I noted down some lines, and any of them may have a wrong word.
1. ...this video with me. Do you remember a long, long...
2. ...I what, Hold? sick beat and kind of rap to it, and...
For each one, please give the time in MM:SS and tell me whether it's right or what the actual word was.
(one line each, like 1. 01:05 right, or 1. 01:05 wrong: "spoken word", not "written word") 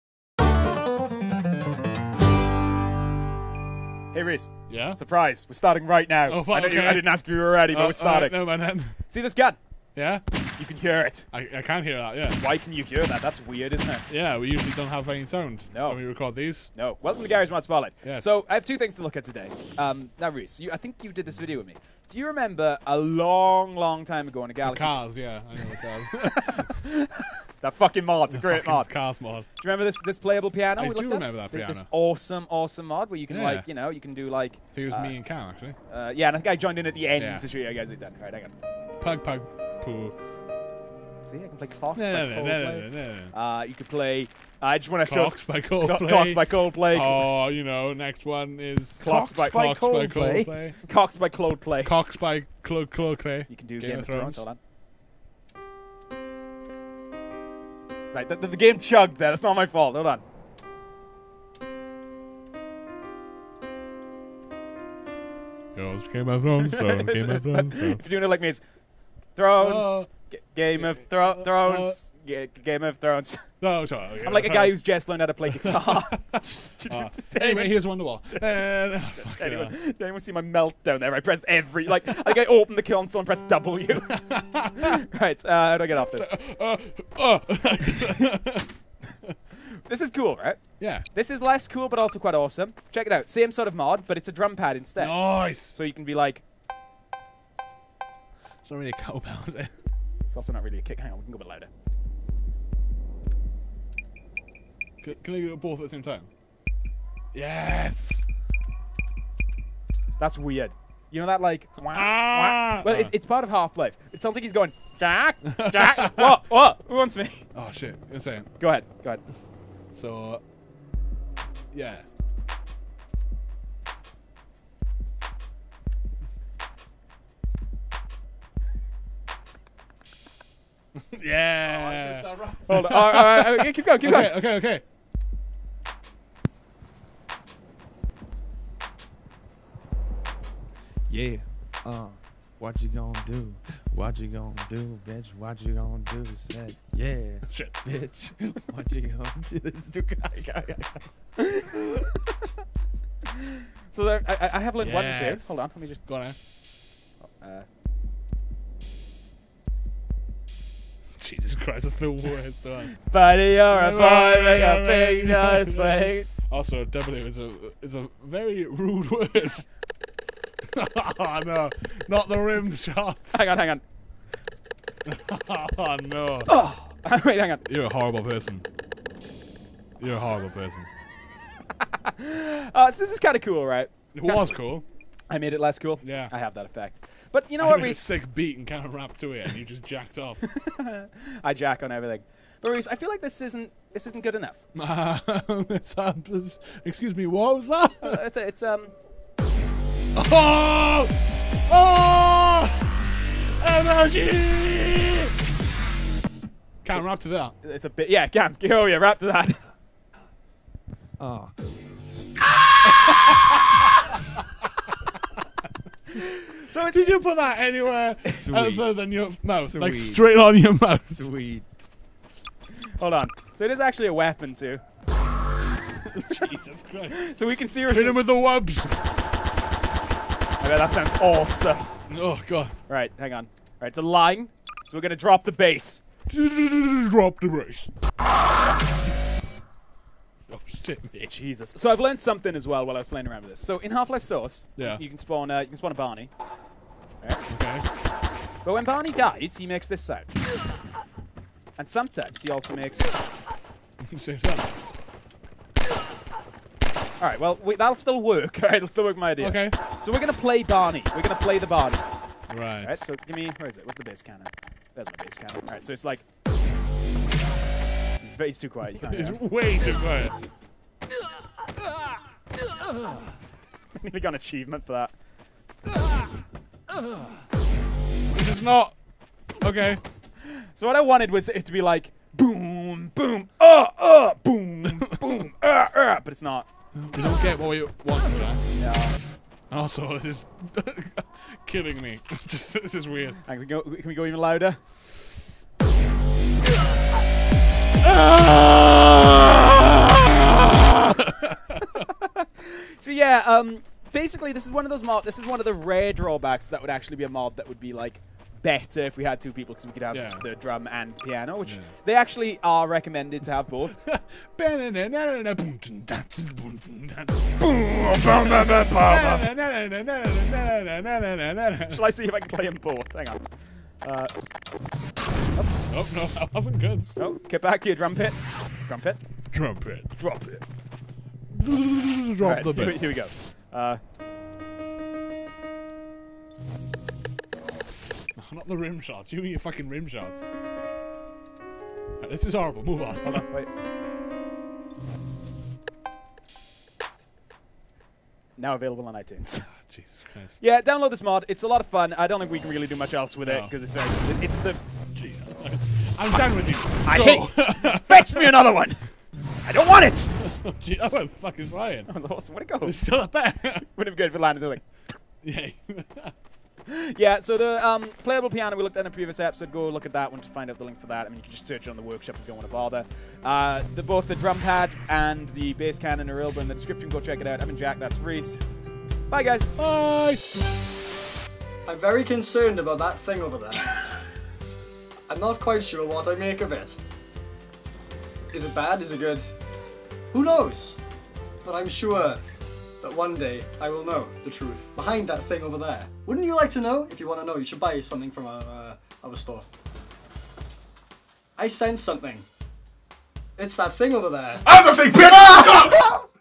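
1. 00:21 right
2. 03:07 wrong: "Rhys", not "Hold".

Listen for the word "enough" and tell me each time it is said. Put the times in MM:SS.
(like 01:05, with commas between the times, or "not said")
03:14.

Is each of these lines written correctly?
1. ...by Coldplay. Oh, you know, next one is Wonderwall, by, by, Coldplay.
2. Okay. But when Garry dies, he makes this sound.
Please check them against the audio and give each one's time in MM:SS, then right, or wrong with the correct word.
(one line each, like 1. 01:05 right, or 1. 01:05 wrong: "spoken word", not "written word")
1. 00:46 wrong: "Clocks", not "Wonderwall"
2. 04:07 wrong: "Barney", not "Garry".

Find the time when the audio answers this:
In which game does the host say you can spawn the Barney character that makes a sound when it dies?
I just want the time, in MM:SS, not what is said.
04:03.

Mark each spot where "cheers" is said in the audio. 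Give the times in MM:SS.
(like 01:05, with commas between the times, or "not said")
not said.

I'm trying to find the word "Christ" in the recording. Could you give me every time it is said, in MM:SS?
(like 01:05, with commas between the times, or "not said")
02:41, 03:46.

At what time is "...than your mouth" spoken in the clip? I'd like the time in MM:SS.
03:38.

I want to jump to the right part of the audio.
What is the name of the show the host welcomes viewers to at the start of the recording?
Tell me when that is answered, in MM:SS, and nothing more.
00:17.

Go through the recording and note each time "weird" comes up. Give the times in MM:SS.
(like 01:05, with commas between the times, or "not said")
00:13, 01:50, 04:53.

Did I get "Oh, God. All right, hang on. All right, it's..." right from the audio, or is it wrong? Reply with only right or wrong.
right.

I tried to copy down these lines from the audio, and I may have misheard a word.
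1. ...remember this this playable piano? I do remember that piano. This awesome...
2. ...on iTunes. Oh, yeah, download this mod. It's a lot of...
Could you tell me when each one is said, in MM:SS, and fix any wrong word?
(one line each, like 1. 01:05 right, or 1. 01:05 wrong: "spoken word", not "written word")
1. 00:29 right
2. 05:49 right.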